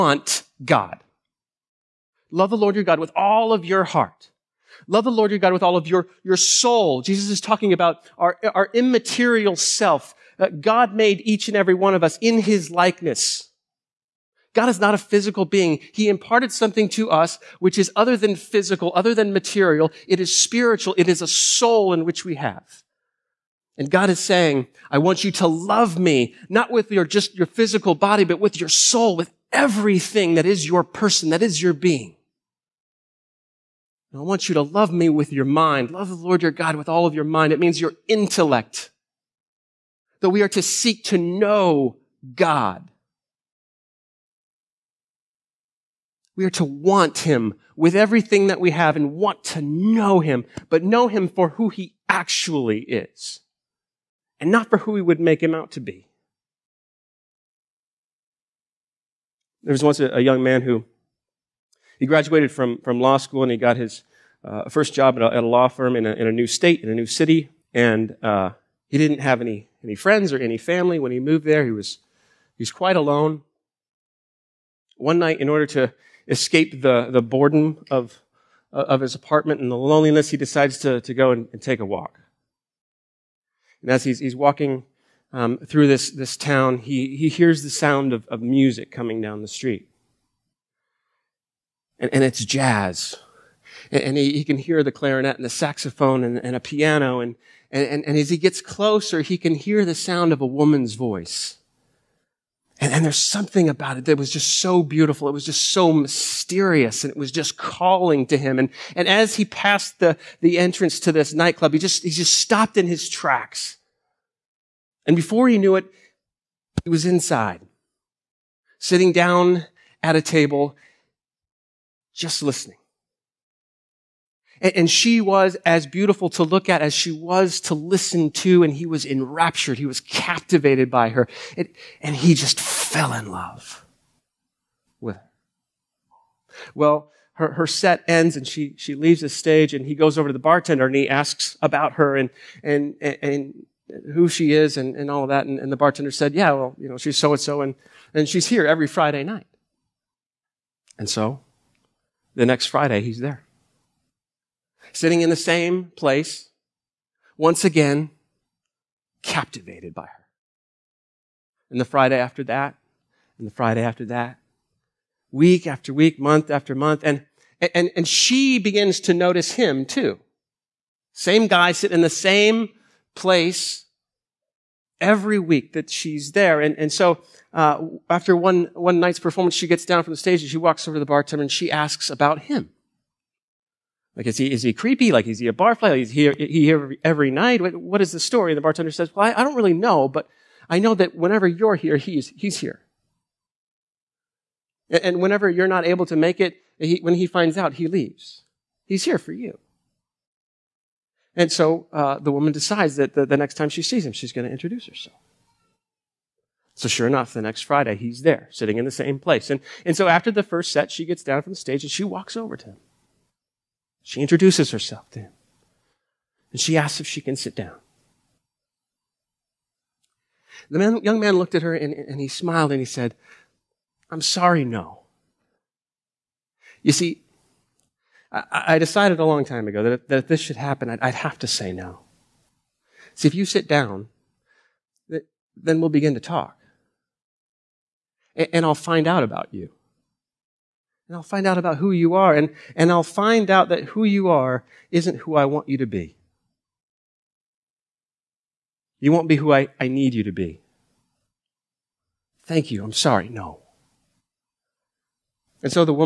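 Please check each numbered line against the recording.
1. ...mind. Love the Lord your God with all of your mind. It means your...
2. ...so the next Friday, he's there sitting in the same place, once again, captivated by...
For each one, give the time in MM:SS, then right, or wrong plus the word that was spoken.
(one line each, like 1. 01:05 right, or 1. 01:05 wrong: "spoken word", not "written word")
1. 00:35 right
2. 02:31 right.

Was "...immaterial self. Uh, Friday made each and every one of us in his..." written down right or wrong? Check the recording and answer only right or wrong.
wrong.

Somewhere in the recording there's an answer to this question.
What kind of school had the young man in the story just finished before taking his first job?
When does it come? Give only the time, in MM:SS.
01:02.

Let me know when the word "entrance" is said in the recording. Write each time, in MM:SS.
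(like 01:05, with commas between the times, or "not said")
01:50.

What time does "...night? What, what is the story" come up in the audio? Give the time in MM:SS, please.
03:07.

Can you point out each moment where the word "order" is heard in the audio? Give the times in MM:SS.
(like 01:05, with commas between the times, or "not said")
01:15.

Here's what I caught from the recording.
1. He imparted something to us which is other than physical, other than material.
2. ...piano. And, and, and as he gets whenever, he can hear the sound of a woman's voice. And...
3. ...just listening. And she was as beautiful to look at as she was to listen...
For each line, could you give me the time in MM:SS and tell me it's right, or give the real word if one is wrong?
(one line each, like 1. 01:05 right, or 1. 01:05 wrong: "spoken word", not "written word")
1. 00:15 right
2. 01:36 wrong: "closer", not "whenever"
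3. 02:02 right.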